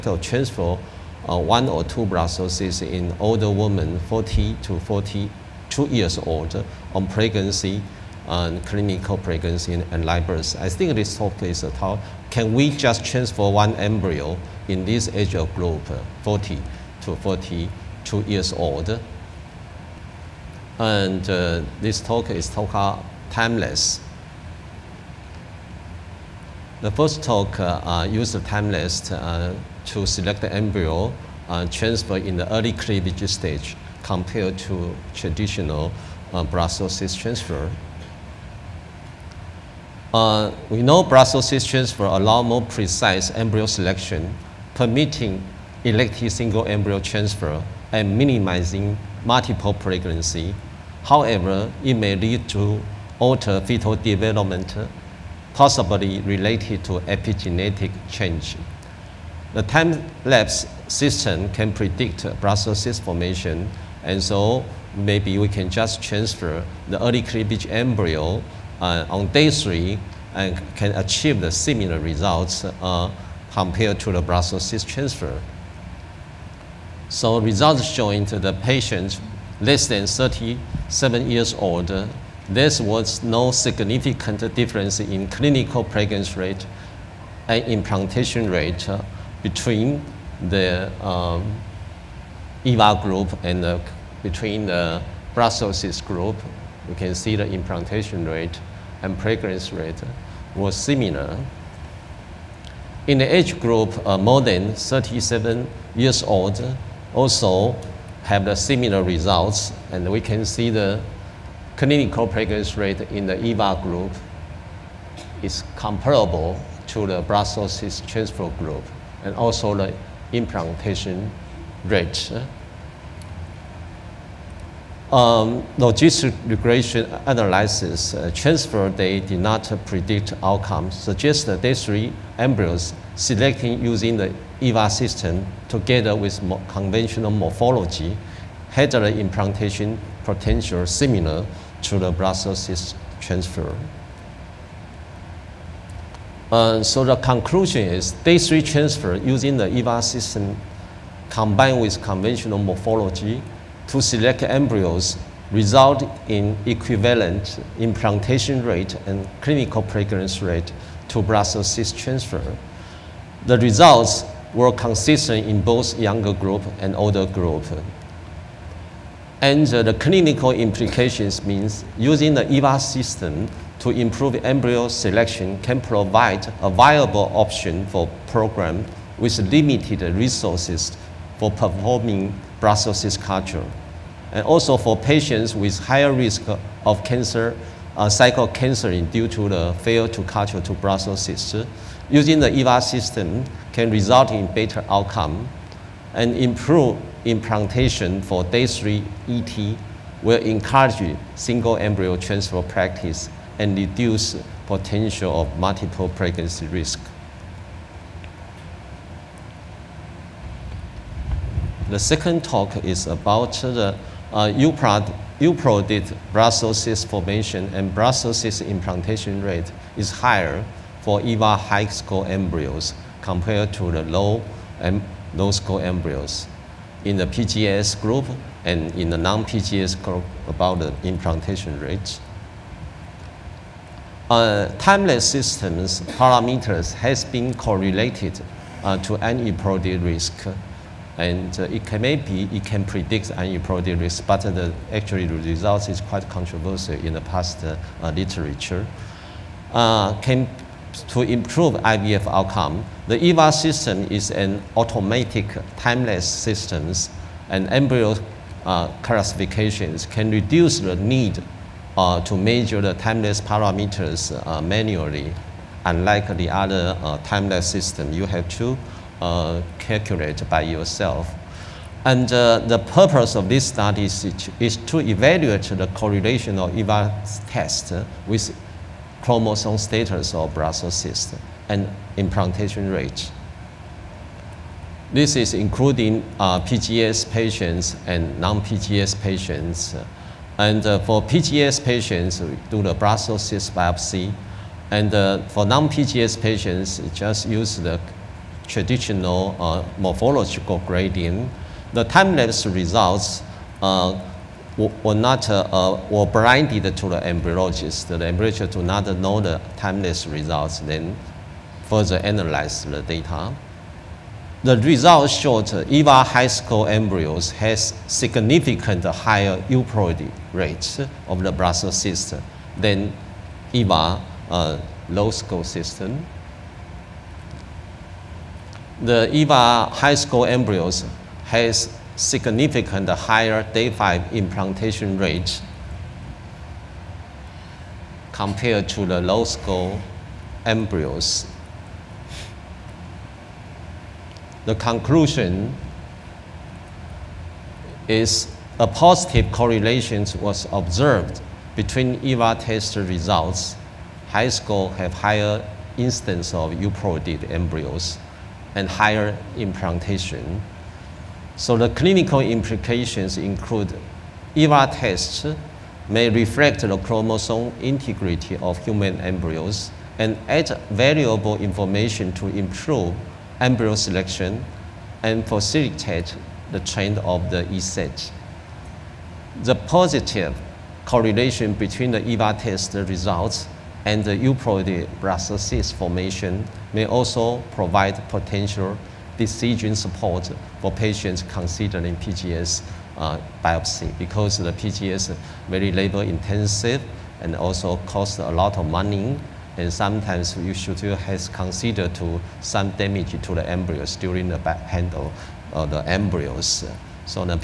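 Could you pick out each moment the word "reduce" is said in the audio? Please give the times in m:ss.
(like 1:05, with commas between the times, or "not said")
3:23, 4:20.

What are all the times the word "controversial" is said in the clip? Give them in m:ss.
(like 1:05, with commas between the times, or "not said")
4:06.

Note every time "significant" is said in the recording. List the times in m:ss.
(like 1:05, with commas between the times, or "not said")
1:23, 5:18, 5:32.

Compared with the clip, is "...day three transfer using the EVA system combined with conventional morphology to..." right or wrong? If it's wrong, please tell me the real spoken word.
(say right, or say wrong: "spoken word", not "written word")
right.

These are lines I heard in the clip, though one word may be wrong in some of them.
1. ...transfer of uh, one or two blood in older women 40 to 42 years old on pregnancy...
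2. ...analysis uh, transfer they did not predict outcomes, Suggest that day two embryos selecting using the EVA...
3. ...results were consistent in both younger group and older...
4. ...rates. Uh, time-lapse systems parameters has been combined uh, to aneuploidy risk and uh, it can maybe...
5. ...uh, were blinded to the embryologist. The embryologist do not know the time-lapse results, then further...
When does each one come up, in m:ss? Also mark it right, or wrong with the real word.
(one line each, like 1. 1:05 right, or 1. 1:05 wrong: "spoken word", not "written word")
1. 0:00 right
2. 2:07 wrong: "three", not "two"
3. 2:43 right
4. 3:51 wrong: "correlated", not "combined"
5. 5:05 right.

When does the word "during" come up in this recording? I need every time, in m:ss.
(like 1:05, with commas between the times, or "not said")
6:44.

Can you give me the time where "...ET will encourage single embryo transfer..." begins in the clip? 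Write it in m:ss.
3:19.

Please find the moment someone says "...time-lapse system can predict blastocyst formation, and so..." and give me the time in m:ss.
0:59.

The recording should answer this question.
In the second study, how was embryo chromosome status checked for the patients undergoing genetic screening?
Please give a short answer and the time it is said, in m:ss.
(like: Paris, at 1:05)
Blastocyst biopsy, at 4:52.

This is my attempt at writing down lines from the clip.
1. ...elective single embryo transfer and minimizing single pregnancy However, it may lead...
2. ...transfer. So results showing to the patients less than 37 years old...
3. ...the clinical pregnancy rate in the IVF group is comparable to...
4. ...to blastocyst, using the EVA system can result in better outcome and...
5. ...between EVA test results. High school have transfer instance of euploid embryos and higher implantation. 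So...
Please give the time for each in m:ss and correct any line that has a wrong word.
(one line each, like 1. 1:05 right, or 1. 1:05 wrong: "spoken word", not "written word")
1. 0:45 wrong: "multiple", not "single"
2. 1:14 right
3. 1:50 wrong: "EVA", not "IVF"
4. 3:10 right
5. 5:51 wrong: "higher", not "transfer".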